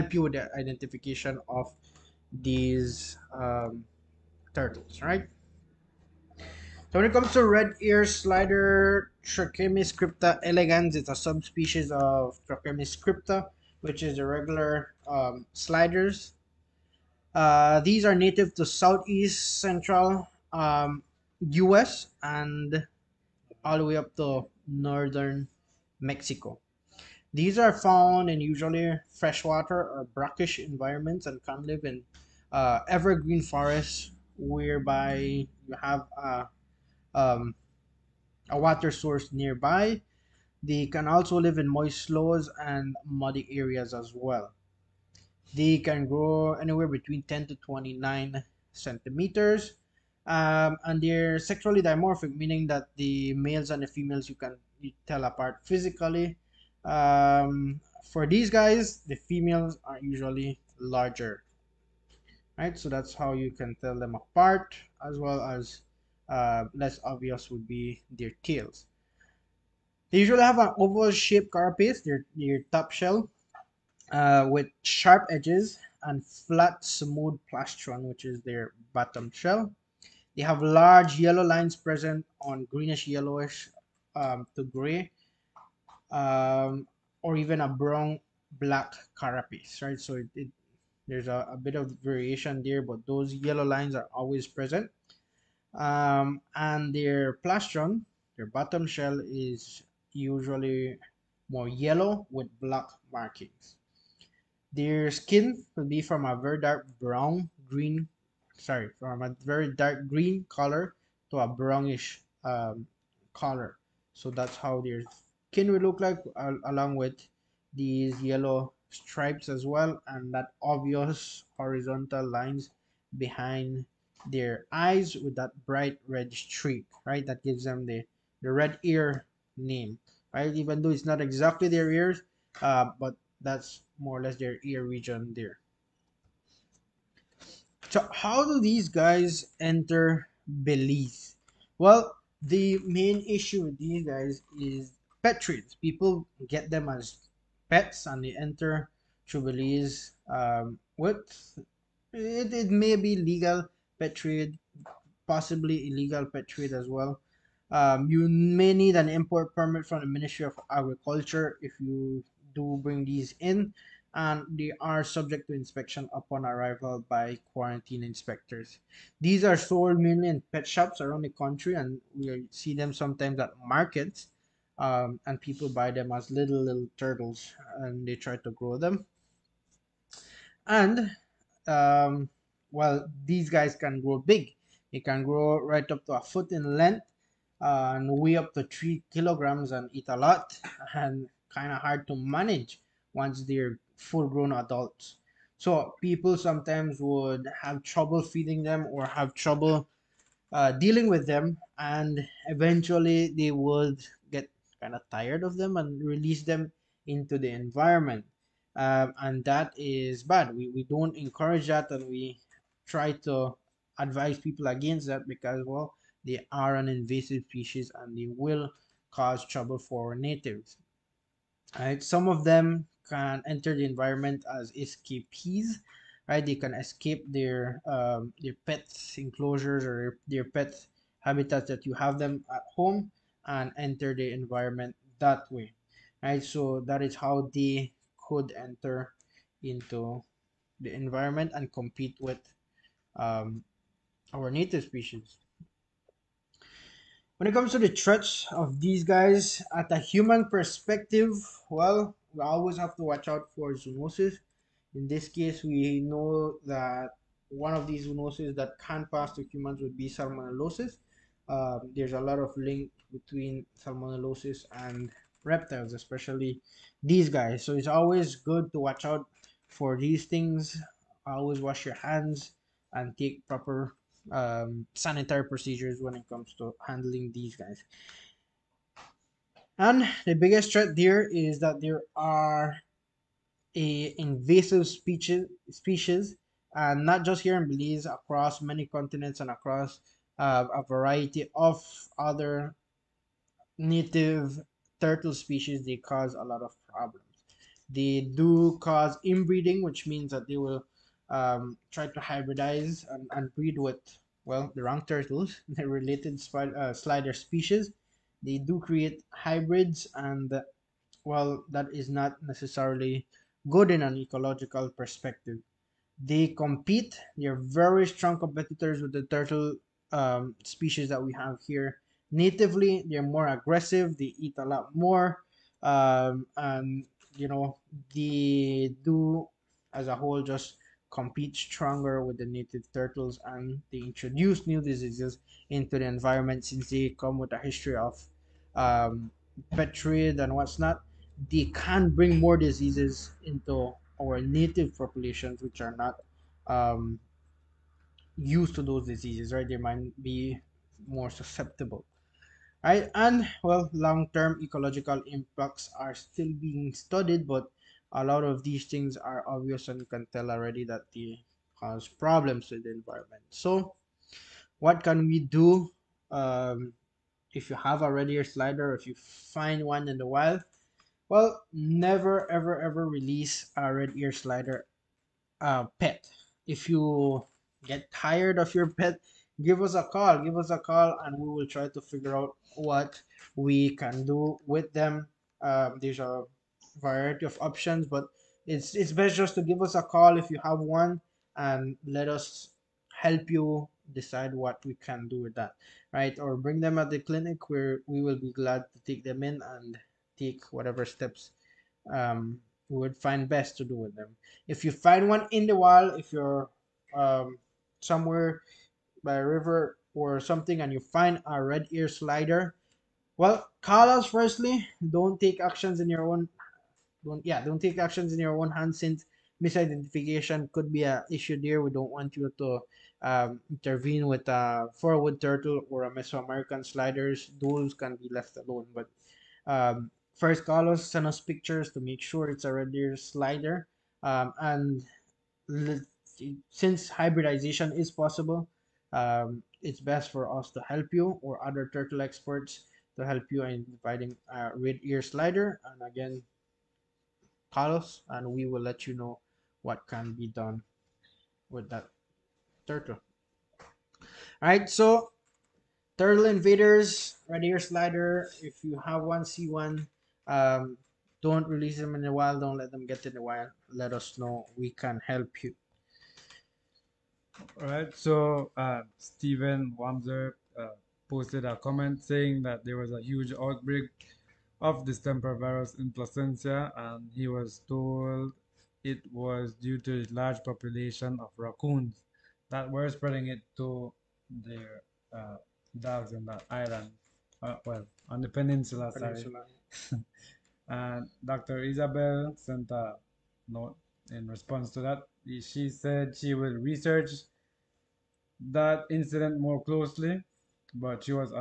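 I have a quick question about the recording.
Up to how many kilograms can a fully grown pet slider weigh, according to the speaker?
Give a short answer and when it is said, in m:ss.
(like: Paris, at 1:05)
3 kilograms, at 3:08.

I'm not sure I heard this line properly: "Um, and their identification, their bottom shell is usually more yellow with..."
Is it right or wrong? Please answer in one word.
wrong.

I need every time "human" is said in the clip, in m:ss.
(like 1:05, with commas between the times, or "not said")
4:09, 4:19.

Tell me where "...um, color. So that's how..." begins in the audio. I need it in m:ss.
1:52.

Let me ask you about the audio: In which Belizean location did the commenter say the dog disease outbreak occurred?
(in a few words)
Placencia.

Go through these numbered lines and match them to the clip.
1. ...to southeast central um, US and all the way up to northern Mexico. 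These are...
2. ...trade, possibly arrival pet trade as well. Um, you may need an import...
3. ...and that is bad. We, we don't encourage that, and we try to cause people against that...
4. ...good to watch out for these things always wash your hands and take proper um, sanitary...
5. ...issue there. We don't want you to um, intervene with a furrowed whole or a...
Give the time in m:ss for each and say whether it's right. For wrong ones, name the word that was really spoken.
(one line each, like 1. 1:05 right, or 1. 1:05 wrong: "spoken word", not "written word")
1. 0:18 right
2. 2:34 wrong: "illegal", not "arrival"
3. 3:29 wrong: "advise", not "cause"
4. 4:28 right
5. 7:01 wrong: "turtle", not "whole".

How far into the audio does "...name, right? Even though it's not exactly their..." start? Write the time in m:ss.
2:09.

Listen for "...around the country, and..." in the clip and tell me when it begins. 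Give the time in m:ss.
2:51.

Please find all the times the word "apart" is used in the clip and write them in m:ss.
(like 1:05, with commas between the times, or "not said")
0:55, 1:04.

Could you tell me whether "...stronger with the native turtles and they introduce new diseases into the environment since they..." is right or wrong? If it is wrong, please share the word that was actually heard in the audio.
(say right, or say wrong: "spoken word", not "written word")
right.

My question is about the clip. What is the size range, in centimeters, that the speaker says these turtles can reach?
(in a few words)
10 to 29 centimeters.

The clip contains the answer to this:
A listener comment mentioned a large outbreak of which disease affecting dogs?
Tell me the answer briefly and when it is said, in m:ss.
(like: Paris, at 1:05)
Distemper, at 7:55.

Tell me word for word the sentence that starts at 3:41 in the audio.
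Right, some of them can enter the environment as escapees.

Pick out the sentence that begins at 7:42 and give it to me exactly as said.
Don't let them get in the wild.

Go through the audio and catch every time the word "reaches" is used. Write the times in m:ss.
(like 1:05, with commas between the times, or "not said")
not said.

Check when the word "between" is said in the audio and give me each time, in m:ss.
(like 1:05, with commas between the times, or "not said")
0:46, 4:23.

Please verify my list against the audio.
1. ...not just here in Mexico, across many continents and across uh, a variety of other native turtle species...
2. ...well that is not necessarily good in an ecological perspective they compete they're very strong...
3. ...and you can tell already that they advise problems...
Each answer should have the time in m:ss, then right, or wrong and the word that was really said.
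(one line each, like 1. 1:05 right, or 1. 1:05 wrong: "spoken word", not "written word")
1. 4:47 wrong: "Belize", not "Mexico"
2. 5:11 right
3. 5:59 wrong: "cause", not "advise".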